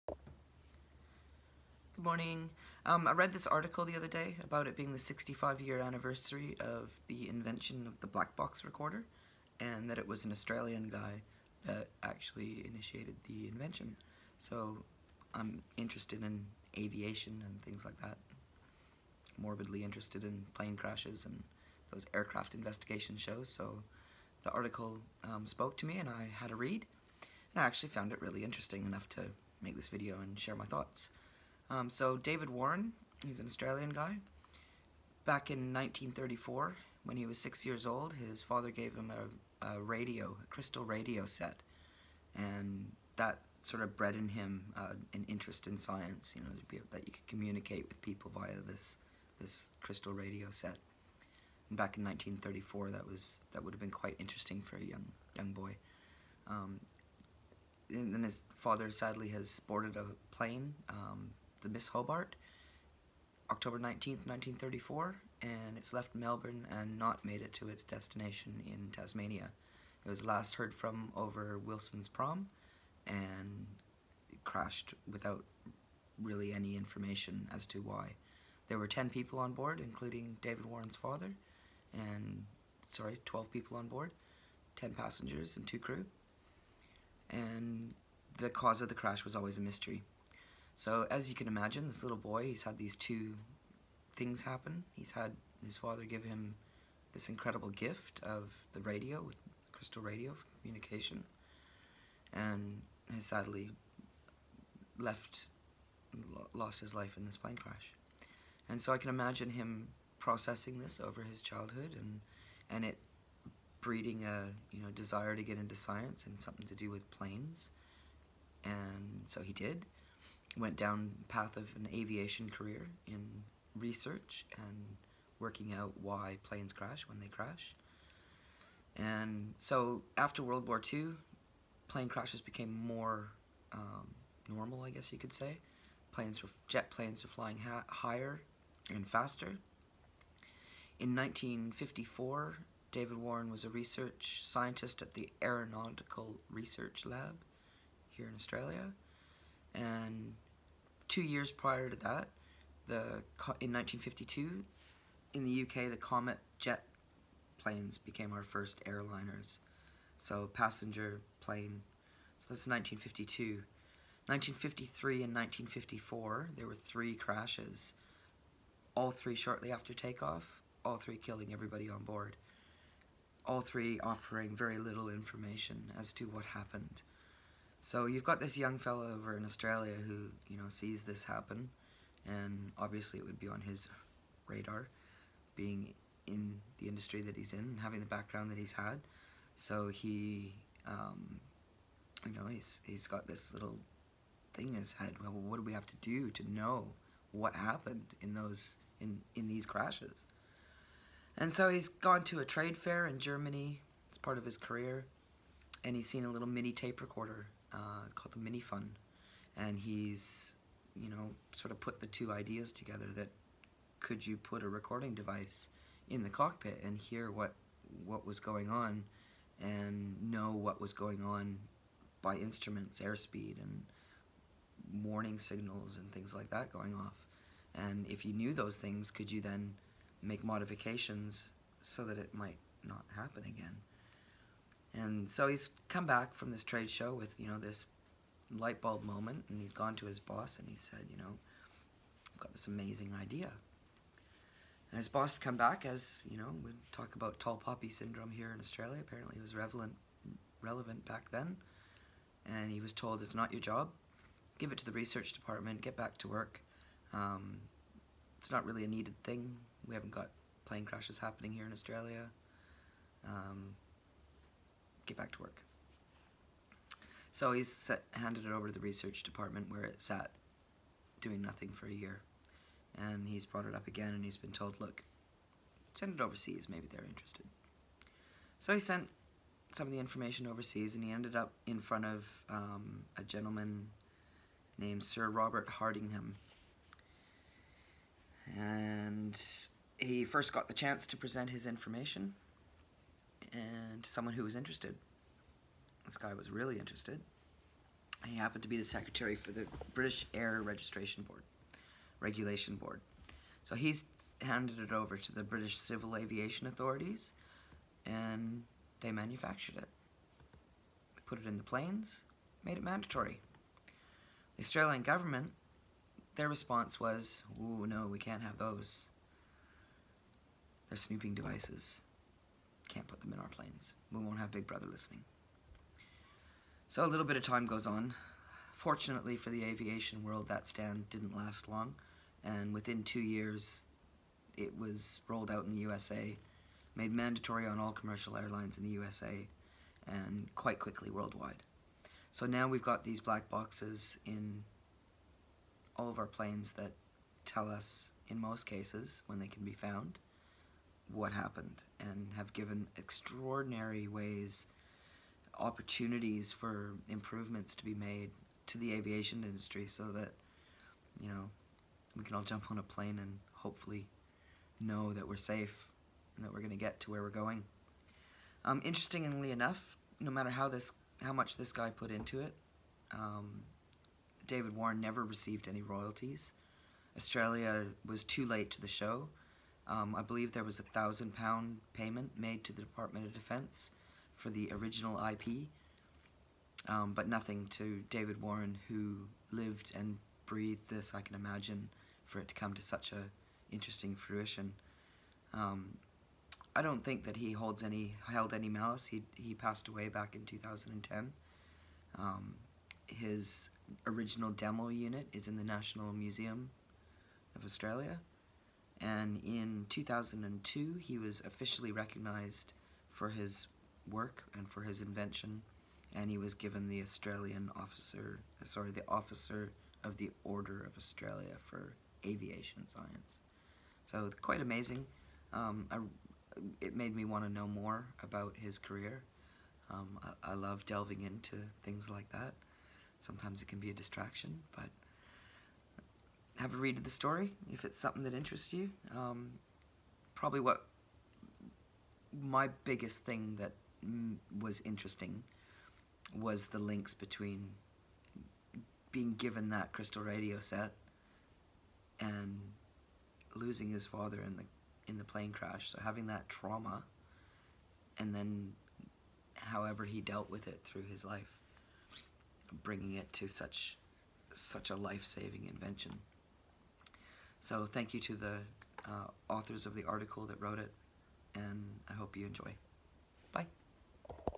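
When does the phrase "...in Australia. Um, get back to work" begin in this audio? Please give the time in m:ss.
4:21.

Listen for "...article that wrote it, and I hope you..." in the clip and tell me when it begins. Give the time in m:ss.
7:50.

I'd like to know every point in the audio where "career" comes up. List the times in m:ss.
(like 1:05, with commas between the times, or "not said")
2:02, 3:24, 7:08.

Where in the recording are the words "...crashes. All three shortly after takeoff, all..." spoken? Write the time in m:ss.
2:47.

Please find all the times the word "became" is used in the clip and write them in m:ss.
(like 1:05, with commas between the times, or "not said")
2:12, 2:37.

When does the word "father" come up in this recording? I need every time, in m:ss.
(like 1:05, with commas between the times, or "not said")
0:38, 0:58, 1:20, 1:35, 7:34.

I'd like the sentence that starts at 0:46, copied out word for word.
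You know, able, that you could communicate with people via this this crystal radio set.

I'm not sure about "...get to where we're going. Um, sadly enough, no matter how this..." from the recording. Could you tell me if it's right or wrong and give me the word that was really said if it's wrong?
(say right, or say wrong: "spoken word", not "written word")
wrong: "interestingly", not "sadly".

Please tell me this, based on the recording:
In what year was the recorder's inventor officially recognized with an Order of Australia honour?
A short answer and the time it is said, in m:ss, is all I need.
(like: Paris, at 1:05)
2002, at 6:49.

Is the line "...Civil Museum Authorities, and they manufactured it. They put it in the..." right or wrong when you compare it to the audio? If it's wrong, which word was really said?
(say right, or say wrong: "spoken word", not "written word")
wrong: "Aviation", not "Museum".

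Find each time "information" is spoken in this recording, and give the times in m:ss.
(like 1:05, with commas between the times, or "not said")
1:16, 2:55, 4:39, 4:51.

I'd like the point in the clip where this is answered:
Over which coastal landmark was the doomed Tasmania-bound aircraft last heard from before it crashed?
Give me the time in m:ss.
1:11.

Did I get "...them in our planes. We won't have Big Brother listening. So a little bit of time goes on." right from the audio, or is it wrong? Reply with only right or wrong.
right.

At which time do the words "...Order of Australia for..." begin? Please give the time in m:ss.
7:00.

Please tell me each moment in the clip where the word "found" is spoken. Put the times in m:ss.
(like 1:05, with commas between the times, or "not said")
0:27, 5:49.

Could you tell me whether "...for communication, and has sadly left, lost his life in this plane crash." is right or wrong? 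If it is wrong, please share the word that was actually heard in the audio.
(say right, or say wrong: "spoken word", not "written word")
right.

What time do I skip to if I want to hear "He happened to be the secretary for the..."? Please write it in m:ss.
4:58.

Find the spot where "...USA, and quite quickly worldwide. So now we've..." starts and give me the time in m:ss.
5:38.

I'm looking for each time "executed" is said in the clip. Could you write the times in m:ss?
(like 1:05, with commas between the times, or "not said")
not said.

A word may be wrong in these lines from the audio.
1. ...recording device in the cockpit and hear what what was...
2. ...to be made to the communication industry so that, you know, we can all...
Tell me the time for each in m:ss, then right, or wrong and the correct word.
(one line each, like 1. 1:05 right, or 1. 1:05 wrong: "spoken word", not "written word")
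1. 3:34 right
2. 5:57 wrong: "aviation", not "communication".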